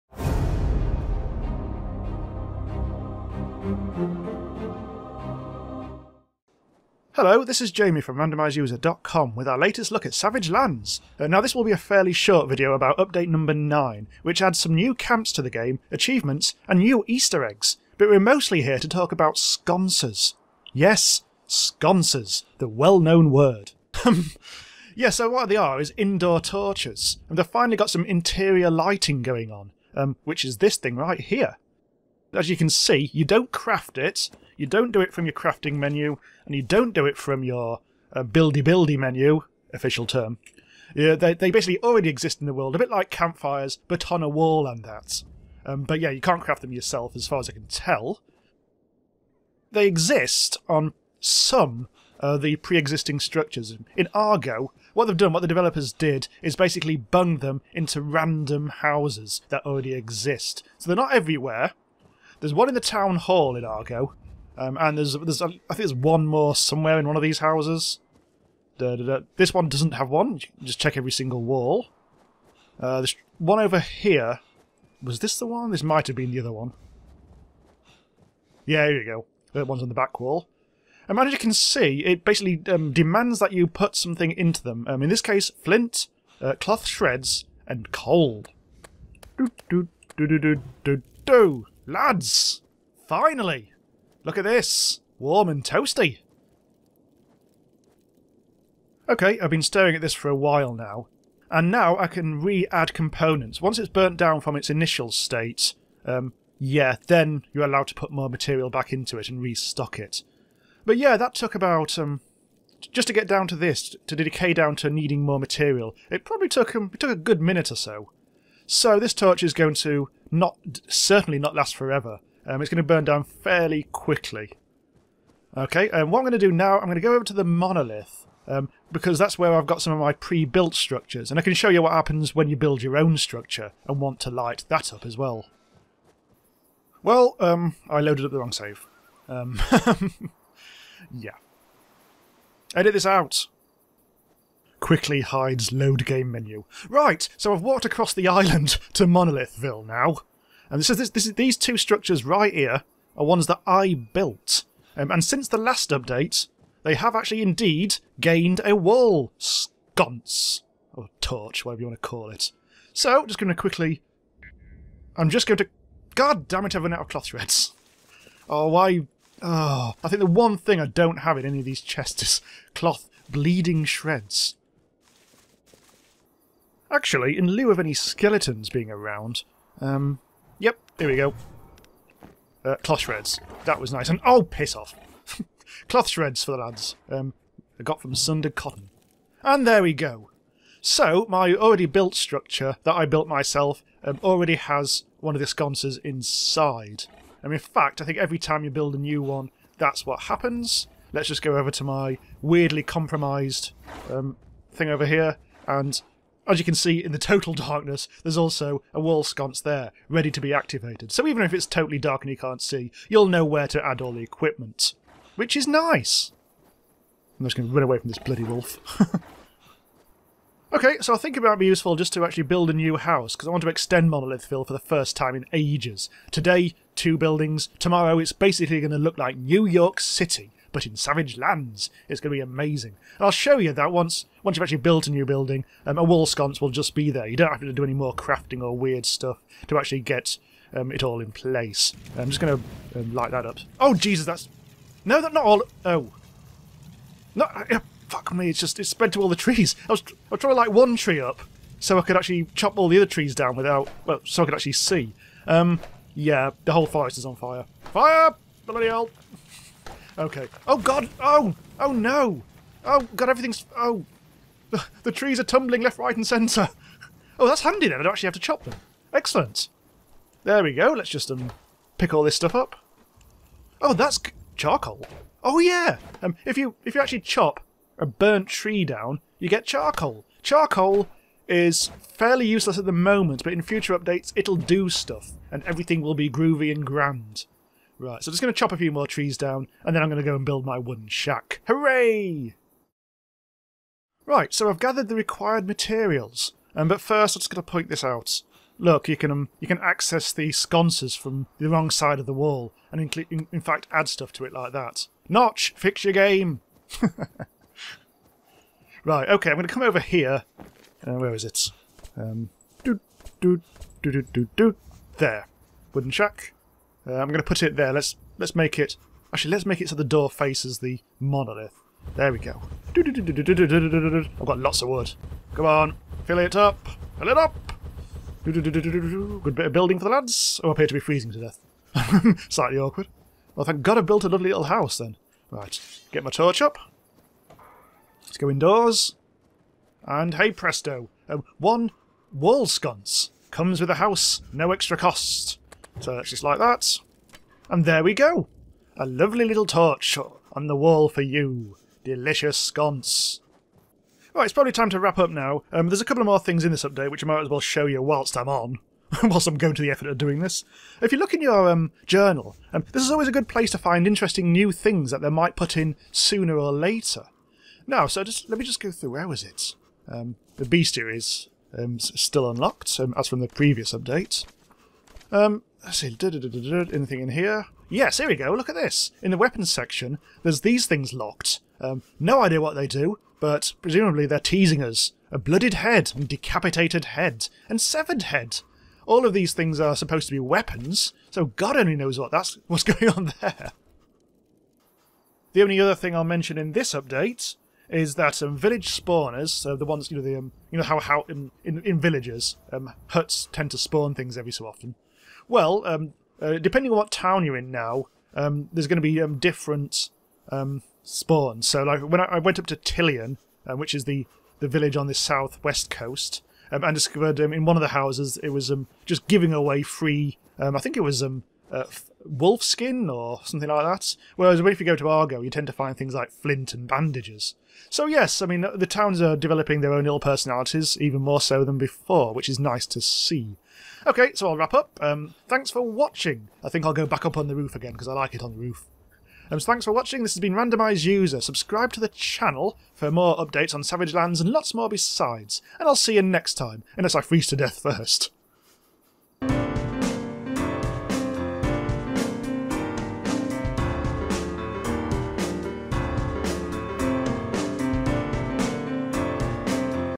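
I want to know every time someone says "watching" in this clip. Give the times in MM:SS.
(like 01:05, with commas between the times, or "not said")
07:15, 07:19.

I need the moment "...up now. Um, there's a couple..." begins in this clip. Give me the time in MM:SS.
05:55.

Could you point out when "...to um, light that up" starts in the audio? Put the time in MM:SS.
04:02.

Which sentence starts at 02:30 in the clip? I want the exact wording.
And this is, this, this is, these two structures right here are ones that I built.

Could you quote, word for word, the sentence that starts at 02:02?
Um, it's going to burn down fairly quickly.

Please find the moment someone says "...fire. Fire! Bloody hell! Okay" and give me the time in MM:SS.
04:17.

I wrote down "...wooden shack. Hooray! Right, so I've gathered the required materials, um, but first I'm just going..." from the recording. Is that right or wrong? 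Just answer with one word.
right.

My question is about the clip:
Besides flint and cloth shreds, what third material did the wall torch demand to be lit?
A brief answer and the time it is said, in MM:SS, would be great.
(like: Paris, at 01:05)
Coal, at 01:27.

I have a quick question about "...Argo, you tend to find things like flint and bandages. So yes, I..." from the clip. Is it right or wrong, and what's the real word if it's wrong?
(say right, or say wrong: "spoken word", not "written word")
right.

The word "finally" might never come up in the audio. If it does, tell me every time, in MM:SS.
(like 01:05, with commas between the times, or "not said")
00:27, 01:33.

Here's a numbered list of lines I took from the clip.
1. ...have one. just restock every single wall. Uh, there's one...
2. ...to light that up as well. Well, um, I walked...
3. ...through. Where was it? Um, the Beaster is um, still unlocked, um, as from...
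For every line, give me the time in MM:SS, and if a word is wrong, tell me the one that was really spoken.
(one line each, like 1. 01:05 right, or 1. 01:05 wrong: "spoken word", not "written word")
1. 01:09 wrong: "check", not "restock"
2. 02:14 wrong: "loaded", not "walked"
3. 06:08 right.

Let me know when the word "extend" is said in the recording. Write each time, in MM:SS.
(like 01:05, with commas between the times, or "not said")
03:43.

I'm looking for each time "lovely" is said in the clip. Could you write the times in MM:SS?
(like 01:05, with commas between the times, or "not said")
05:34, 05:49.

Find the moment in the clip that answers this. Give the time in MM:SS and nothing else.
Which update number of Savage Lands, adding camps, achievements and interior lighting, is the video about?
00:12.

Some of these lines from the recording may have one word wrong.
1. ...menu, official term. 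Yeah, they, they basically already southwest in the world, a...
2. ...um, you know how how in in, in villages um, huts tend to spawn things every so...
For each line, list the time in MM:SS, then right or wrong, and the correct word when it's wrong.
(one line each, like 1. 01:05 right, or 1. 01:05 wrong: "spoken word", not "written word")
1. 00:38 wrong: "exist", not "southwest"
2. 06:40 right.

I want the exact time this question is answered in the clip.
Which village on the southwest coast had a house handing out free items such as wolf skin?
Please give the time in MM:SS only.
06:52.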